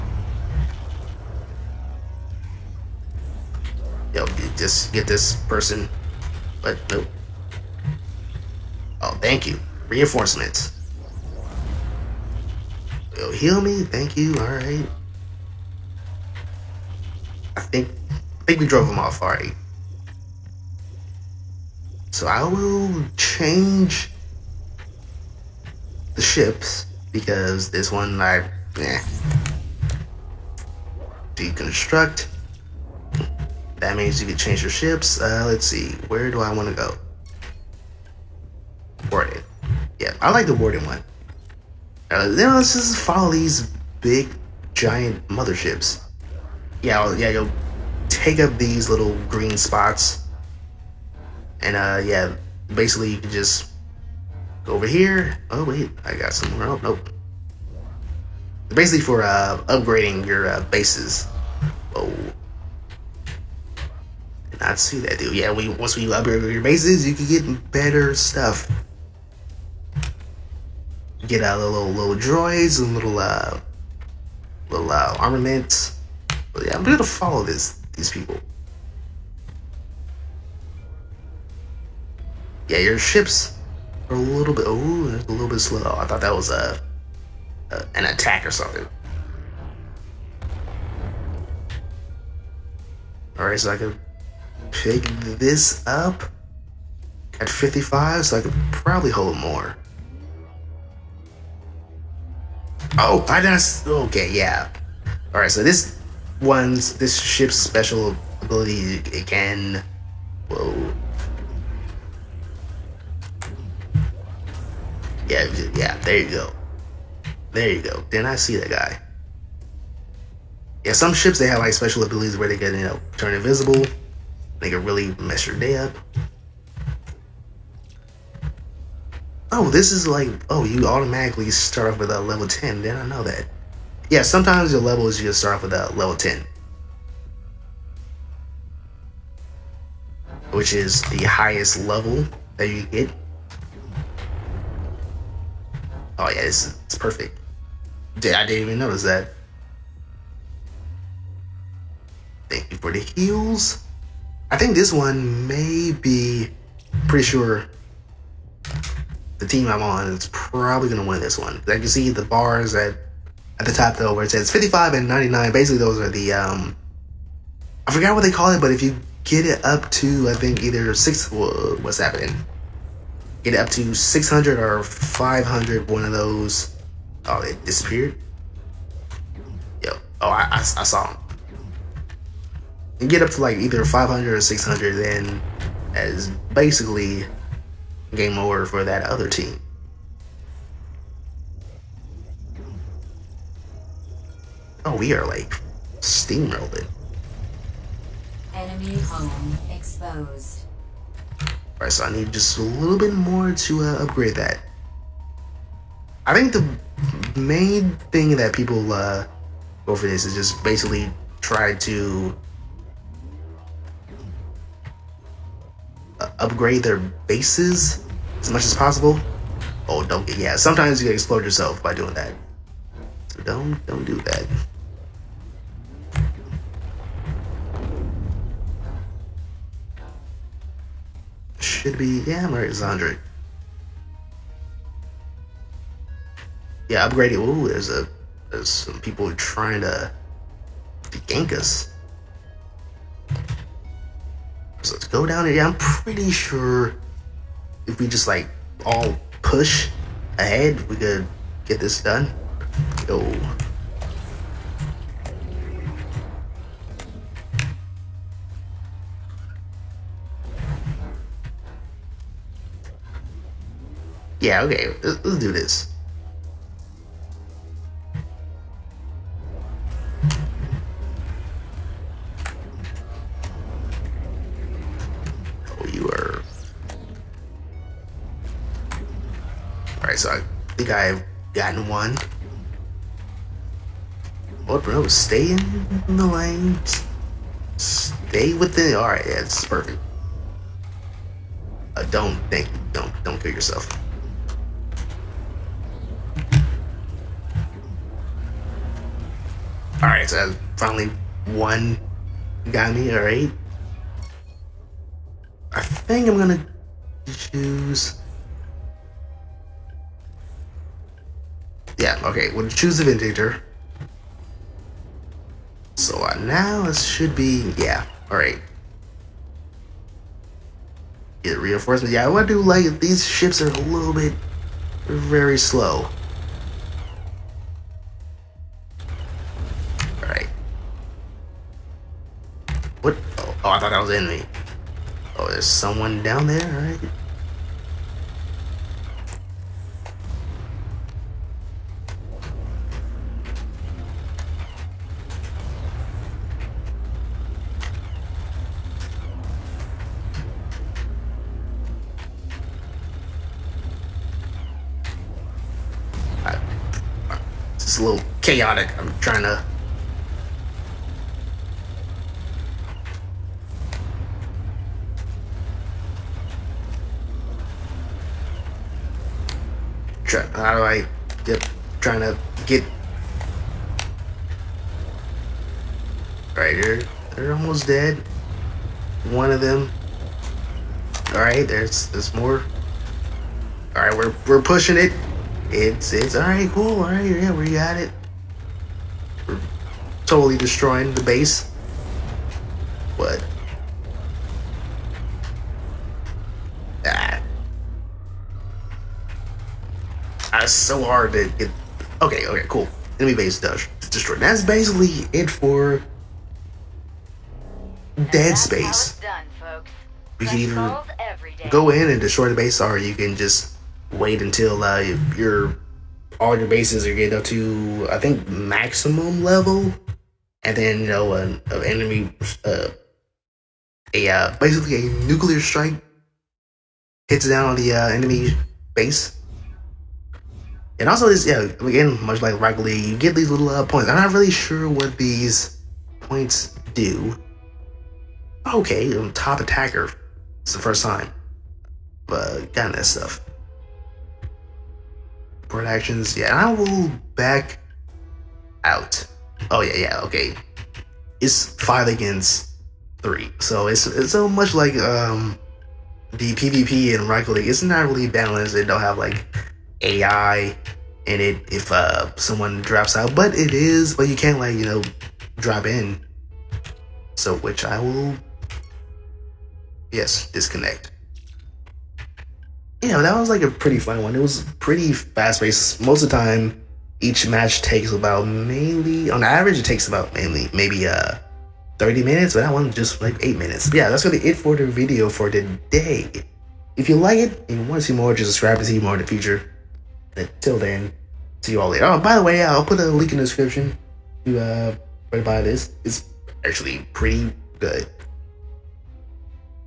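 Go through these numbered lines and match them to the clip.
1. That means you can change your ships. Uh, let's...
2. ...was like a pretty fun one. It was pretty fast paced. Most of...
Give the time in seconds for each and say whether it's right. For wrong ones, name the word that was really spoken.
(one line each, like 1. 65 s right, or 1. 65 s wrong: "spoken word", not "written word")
1. 33 s right
2. 473 s right.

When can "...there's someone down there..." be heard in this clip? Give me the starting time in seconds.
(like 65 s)
335 s.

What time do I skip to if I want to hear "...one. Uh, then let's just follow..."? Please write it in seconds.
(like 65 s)
40 s.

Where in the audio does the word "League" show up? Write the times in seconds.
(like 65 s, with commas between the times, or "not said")
432 s, 457 s.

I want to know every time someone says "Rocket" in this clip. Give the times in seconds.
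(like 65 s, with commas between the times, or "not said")
432 s, 457 s.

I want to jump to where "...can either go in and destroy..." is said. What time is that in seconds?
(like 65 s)
410 s.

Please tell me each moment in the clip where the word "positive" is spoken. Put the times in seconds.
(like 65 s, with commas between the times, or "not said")
not said.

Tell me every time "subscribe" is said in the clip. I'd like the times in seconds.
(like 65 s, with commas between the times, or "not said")
488 s.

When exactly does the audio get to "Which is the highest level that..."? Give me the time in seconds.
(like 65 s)
140 s.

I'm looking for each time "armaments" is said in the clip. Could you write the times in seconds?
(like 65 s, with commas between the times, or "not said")
75 s.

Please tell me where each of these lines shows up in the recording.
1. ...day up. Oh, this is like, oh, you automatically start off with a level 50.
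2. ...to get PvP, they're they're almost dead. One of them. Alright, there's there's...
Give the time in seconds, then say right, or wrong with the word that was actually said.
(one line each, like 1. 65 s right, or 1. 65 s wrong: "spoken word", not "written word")
1. 125 s wrong: "10", not "50"
2. 372 s wrong: "Alright", not "PvP".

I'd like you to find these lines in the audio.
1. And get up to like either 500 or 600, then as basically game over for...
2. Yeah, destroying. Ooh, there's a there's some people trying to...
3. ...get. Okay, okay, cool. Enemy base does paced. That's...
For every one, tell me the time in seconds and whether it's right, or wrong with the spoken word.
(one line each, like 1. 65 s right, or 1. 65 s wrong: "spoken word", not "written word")
1. 183 s right
2. 236 s wrong: "upgrading", not "destroying"
3. 401 s wrong: "destroyed", not "paced".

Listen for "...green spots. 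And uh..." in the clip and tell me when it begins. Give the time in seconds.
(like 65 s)
49 s.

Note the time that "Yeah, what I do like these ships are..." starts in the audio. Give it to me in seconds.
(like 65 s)
322 s.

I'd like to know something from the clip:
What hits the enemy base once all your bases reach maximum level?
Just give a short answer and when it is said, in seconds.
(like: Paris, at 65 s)
a nuclear strike, at 425 s.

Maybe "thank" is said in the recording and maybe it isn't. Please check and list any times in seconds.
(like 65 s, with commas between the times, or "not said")
9 s, 13 s, 152 s.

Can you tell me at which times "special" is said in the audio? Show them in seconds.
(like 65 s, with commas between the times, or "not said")
107 s, 121 s.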